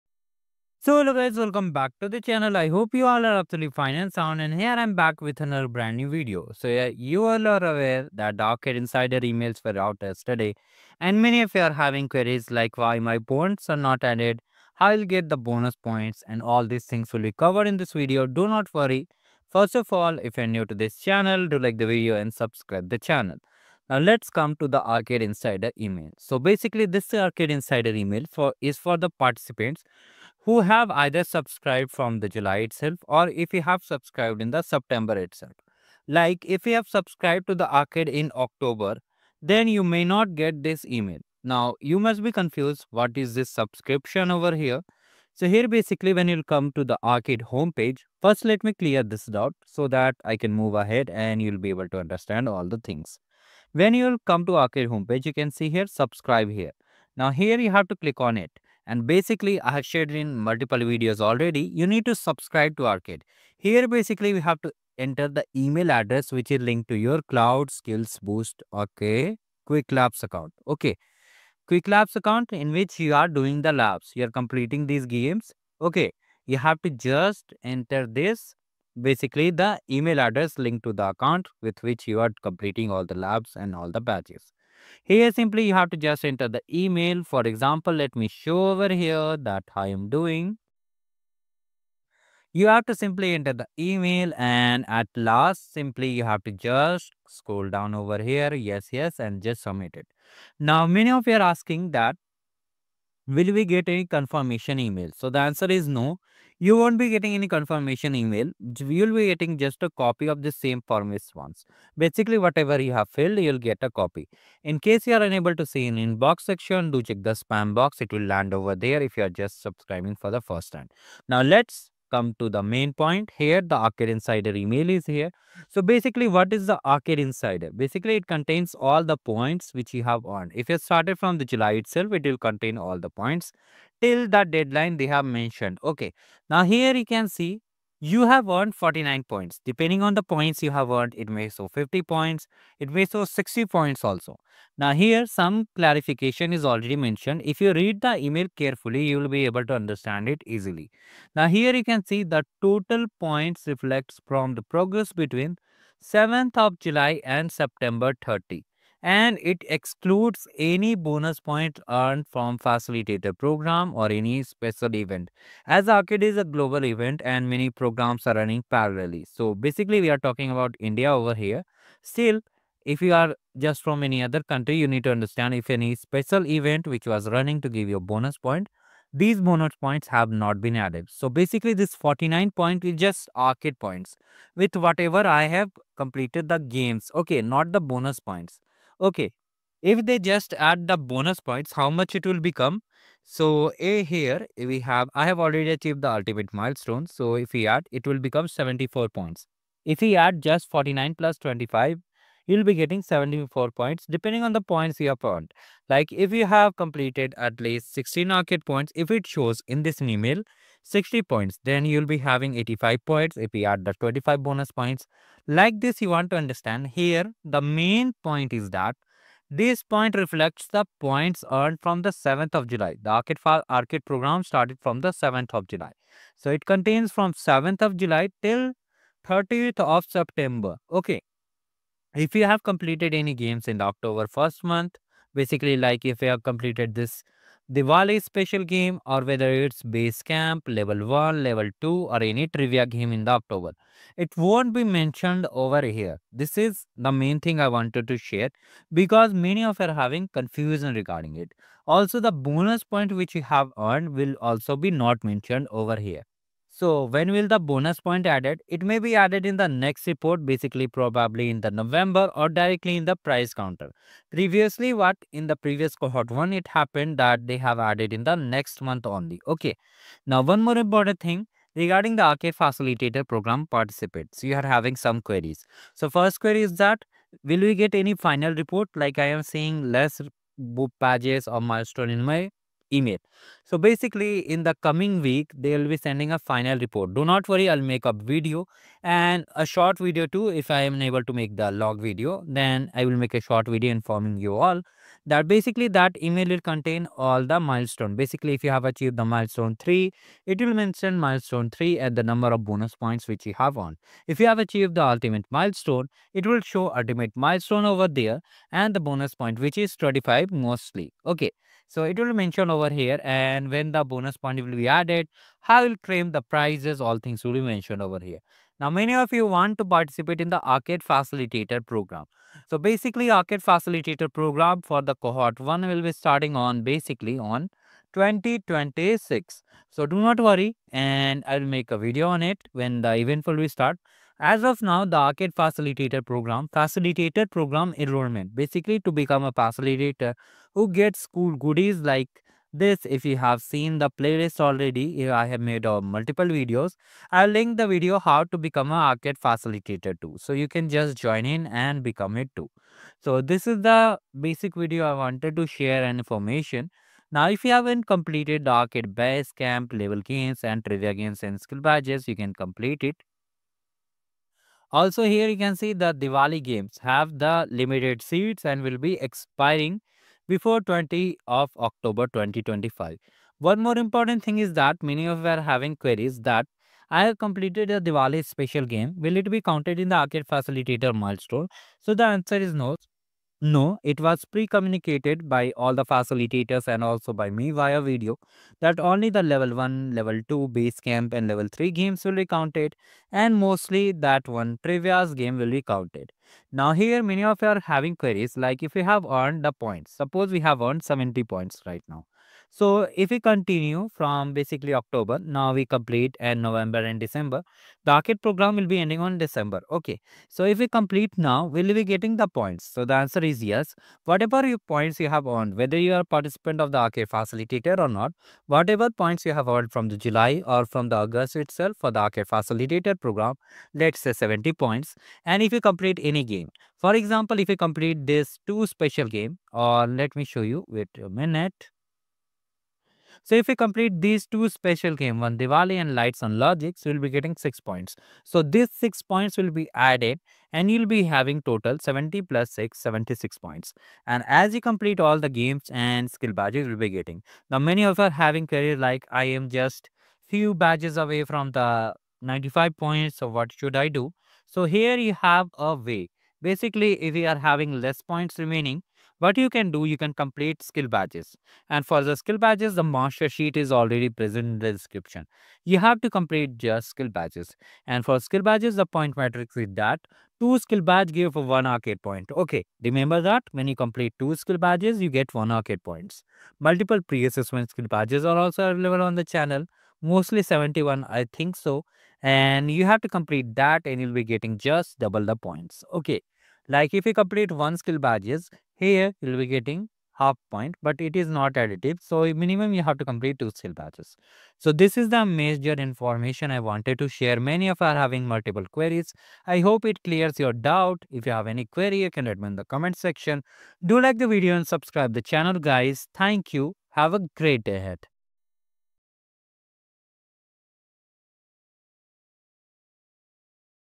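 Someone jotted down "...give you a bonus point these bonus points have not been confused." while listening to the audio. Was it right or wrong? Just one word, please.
wrong.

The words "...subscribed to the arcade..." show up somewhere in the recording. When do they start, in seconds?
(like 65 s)
36 s.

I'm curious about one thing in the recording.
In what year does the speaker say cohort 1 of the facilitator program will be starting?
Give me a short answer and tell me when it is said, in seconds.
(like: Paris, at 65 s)
2026, at 328 s.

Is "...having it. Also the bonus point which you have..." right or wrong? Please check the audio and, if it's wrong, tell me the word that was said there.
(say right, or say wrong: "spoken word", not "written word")
wrong: "regarding", not "having".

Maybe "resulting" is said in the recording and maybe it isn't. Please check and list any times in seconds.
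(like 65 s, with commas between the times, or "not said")
not said.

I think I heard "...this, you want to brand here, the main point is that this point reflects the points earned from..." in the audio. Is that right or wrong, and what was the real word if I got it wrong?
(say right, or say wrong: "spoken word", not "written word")
wrong: "understand", not "brand".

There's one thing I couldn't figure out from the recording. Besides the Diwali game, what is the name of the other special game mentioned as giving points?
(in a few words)
Lights on Logic.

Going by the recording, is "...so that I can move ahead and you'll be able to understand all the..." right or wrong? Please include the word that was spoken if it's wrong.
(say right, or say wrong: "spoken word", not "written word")
right.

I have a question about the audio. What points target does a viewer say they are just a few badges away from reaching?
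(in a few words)
95.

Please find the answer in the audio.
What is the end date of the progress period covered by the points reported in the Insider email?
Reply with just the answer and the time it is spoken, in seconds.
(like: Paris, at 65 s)
September 30, at 157 s.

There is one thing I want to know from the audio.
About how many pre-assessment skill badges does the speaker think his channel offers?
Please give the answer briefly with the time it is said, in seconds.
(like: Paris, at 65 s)
71, at 480 s.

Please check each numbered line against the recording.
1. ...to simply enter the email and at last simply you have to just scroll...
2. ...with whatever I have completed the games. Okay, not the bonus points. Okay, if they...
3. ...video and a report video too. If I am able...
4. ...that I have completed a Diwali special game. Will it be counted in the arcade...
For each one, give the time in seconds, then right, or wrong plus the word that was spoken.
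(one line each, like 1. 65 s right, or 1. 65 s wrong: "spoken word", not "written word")
1. 92 s right
2. 184 s right
3. 288 s wrong: "short", not "report"
4. 376 s right.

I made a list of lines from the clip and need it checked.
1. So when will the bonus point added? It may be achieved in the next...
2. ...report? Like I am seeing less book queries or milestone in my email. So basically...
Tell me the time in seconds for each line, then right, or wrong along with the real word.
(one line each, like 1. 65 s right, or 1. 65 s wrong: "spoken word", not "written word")
1. 256 s wrong: "added", not "achieved"
2. 278 s wrong: "pages", not "queries".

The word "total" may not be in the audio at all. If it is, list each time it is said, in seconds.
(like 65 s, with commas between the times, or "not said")
152 s, 441 s.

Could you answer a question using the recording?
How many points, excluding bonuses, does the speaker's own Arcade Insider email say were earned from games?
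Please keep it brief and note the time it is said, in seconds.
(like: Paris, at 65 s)
49, at 138 s.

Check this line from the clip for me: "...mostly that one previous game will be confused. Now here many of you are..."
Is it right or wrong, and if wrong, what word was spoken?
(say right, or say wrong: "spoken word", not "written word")
wrong: "counted", not "confused".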